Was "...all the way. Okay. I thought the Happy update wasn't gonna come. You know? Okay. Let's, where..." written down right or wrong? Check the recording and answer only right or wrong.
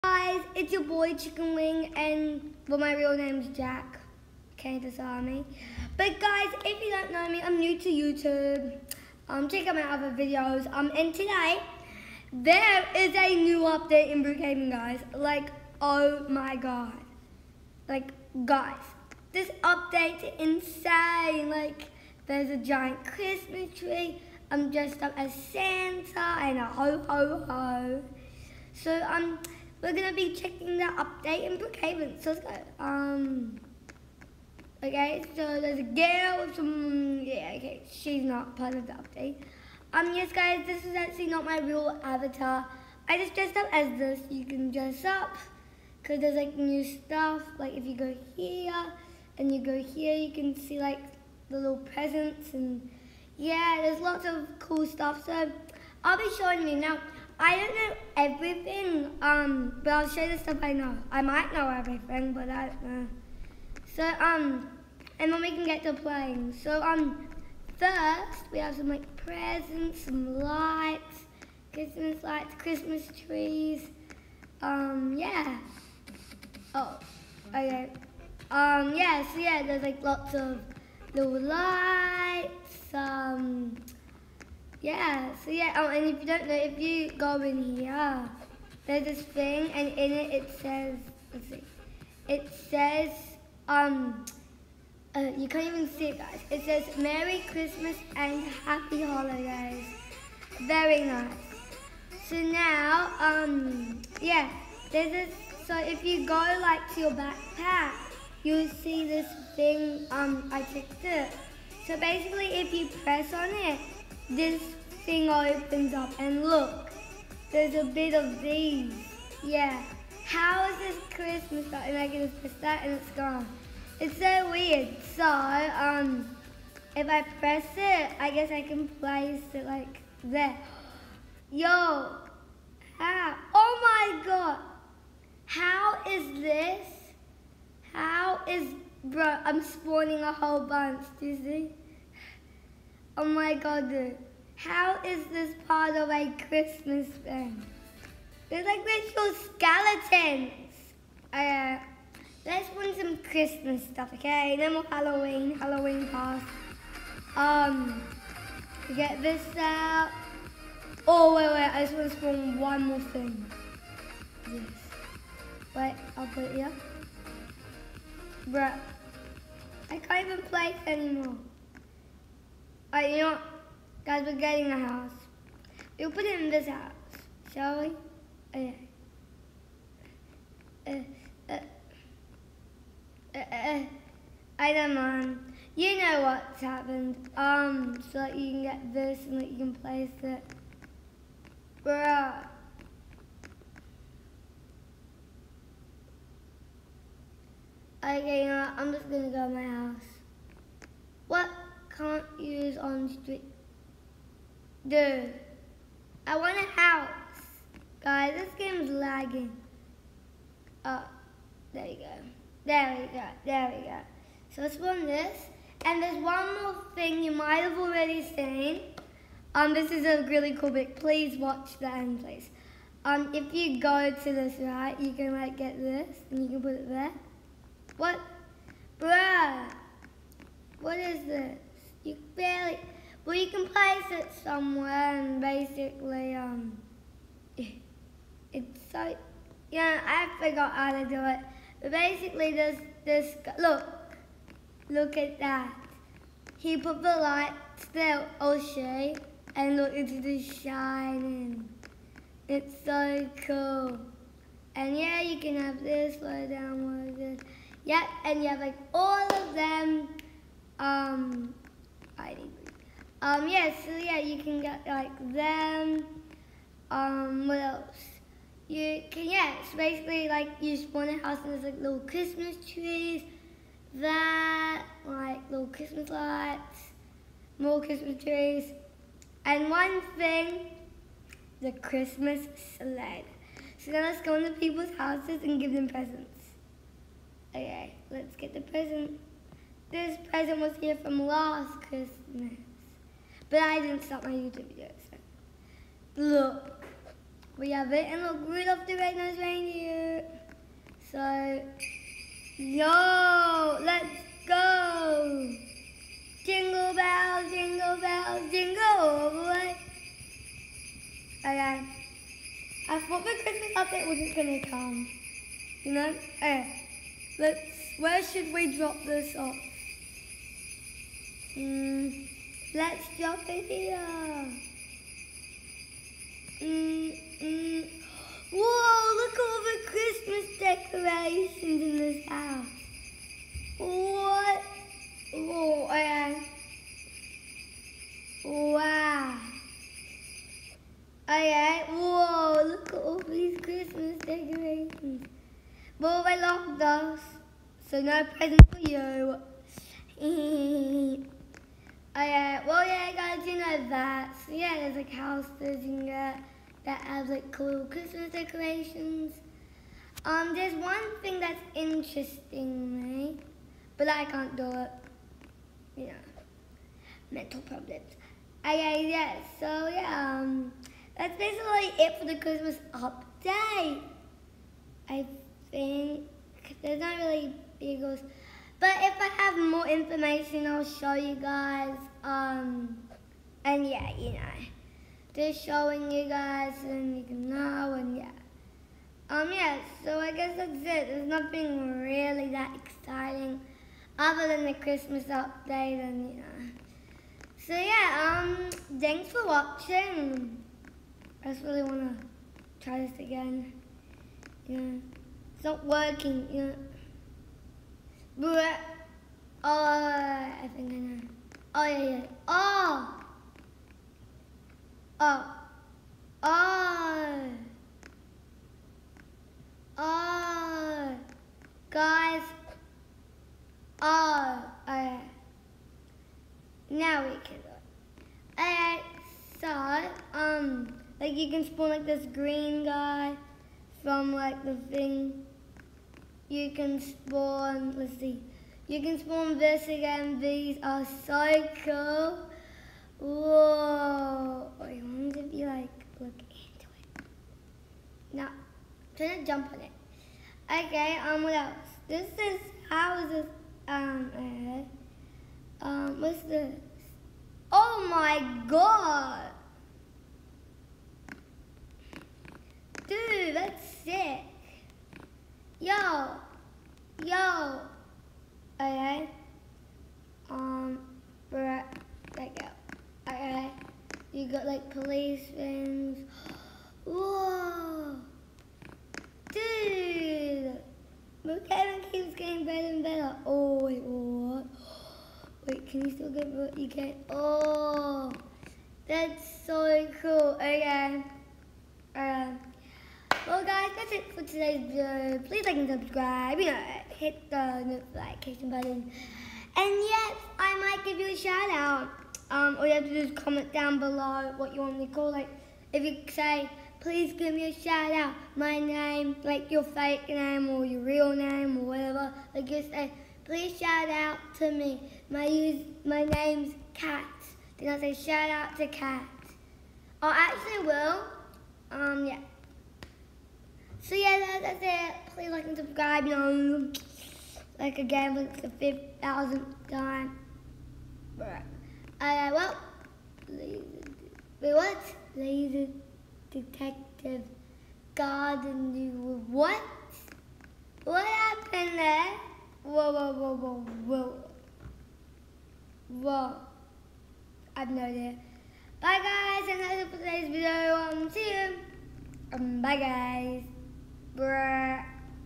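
wrong.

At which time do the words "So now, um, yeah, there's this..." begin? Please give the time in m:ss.
1:42.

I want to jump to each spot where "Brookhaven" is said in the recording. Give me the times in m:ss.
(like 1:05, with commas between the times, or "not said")
0:14, 0:31.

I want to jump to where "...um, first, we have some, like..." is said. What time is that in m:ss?
1:06.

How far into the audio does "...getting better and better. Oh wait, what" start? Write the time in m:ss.
8:02.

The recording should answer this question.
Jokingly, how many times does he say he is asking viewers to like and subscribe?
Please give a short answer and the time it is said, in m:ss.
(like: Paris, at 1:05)
5,000th, at 8:49.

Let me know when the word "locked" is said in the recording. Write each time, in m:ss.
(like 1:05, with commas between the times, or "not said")
5:46.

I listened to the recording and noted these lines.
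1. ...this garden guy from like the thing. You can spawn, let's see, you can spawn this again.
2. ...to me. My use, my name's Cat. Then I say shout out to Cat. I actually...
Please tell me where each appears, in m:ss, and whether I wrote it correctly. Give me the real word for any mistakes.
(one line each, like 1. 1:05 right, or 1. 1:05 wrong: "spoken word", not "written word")
1. 7:12 wrong: "green", not "garden"
2. 8:34 right.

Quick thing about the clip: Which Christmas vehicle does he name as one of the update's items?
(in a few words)
Christmas sled.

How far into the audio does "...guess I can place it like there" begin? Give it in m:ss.
2:08.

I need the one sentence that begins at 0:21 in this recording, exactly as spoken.
Like, there's a giant Christmas tree.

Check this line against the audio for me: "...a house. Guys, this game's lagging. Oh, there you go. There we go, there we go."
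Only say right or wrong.
right.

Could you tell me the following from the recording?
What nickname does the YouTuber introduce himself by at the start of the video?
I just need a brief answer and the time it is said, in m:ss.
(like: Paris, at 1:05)
Chicken Wing, at 0:01.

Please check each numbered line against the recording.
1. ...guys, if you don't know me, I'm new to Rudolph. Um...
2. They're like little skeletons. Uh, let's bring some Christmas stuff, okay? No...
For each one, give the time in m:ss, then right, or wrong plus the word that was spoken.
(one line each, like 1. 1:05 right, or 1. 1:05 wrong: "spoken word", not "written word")
1. 0:06 wrong: "YouTube", not "Rudolph"
2. 2:28 right.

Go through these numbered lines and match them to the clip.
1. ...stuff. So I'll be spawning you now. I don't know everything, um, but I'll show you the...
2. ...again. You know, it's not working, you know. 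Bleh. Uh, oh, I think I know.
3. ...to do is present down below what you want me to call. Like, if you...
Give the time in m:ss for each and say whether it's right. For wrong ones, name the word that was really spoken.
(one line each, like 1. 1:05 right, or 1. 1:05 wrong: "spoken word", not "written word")
1. 0:54 wrong: "showing", not "spawning"
2. 6:43 right
3. 8:23 wrong: "comment", not "present".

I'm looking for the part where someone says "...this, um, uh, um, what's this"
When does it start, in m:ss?
7:33.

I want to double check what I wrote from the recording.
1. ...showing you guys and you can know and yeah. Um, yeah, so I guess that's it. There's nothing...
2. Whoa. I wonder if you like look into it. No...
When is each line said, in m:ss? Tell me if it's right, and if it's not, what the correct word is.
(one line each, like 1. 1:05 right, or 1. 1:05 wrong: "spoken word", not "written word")
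1. 6:25 right
2. 7:23 right.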